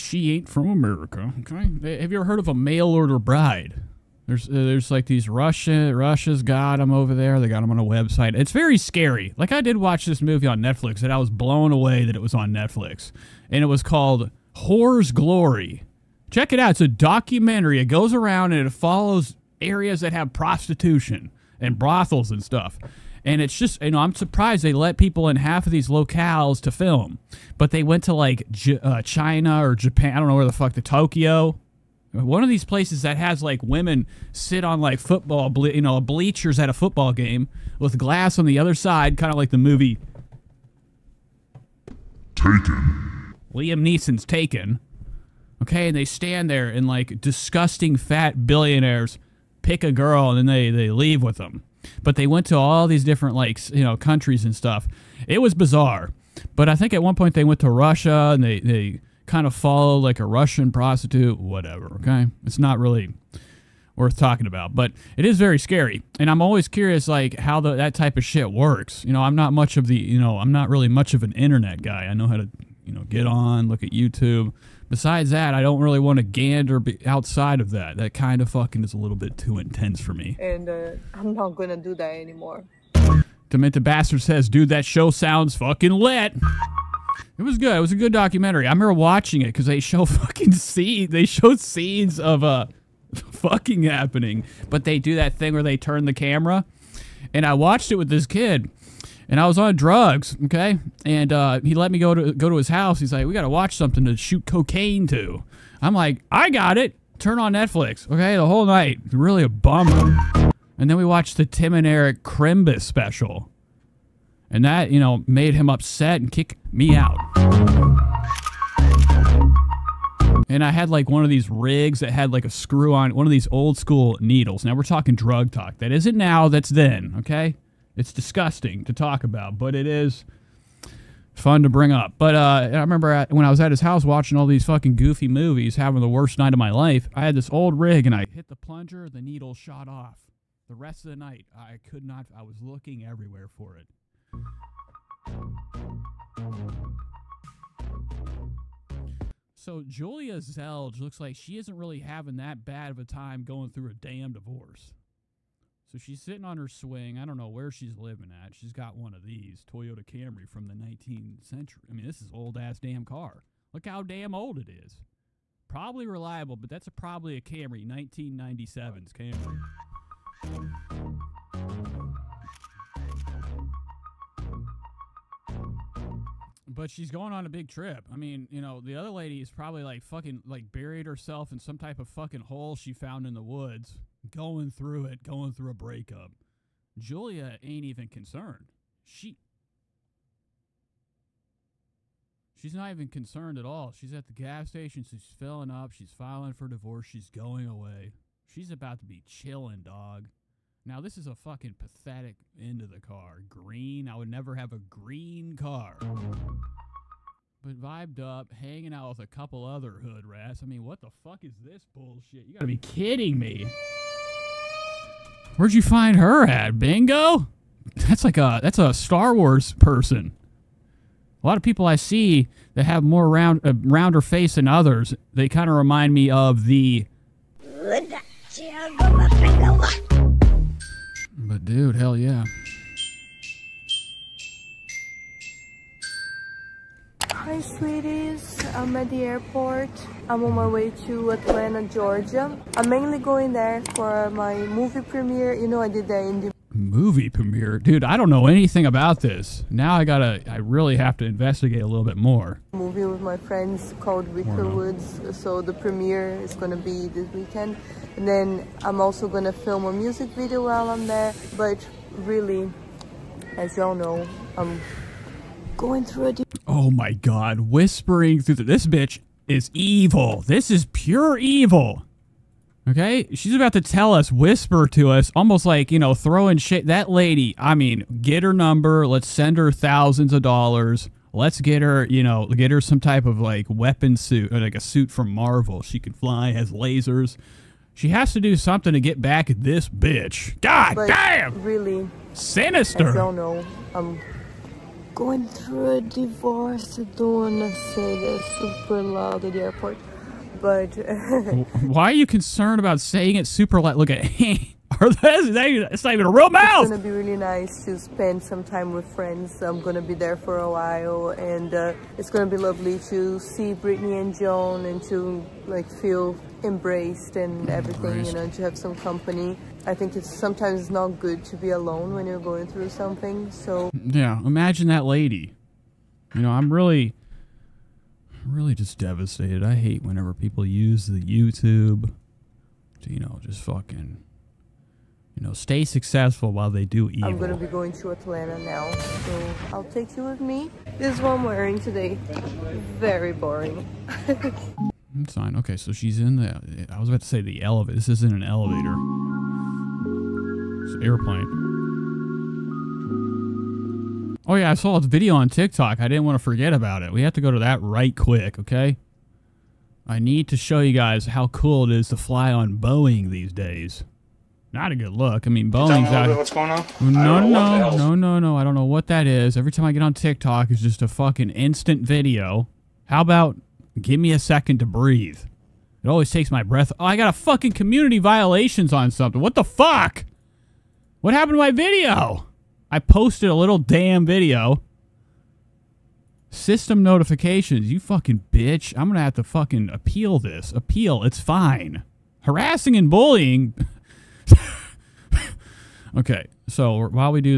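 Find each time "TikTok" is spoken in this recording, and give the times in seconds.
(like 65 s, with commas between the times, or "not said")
355 s, 370 s.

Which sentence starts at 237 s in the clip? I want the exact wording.
Hi sweeties, I'm at the airport.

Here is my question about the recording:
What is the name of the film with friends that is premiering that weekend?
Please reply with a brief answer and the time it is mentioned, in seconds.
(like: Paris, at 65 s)
Wicker Woods, at 254 s.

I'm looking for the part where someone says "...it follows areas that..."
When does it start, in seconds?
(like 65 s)
18 s.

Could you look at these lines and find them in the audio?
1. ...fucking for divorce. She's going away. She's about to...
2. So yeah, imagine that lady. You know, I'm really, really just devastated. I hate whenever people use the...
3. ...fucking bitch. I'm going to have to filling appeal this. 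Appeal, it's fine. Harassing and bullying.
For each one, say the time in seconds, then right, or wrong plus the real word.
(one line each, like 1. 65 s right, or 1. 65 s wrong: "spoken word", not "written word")
1. 196 s wrong: "filing", not "fucking"
2. 323 s right
3. 387 s wrong: "fucking", not "filling".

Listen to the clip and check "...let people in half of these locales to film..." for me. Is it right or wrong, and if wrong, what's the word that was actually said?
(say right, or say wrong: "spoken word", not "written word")
right.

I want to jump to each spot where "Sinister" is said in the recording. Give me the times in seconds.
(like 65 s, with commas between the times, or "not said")
292 s.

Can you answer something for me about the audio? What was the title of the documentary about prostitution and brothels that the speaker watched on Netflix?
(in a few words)
Whore's Glory.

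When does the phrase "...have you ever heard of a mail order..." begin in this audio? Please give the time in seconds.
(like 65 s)
1 s.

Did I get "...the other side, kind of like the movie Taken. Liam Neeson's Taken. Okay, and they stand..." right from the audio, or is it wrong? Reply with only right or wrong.
right.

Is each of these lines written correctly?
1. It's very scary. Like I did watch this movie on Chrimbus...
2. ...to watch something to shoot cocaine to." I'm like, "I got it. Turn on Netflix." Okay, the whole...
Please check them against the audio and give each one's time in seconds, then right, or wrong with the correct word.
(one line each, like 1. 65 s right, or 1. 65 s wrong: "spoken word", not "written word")
1. 8 s wrong: "Netflix", not "Chrimbus"
2. 103 s right.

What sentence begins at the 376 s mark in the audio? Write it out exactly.
Oh, I got a fucking community violations on something.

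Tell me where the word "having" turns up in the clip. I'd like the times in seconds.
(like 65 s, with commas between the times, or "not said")
135 s, 151 s.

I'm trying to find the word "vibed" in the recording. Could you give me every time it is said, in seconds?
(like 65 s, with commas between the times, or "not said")
207 s.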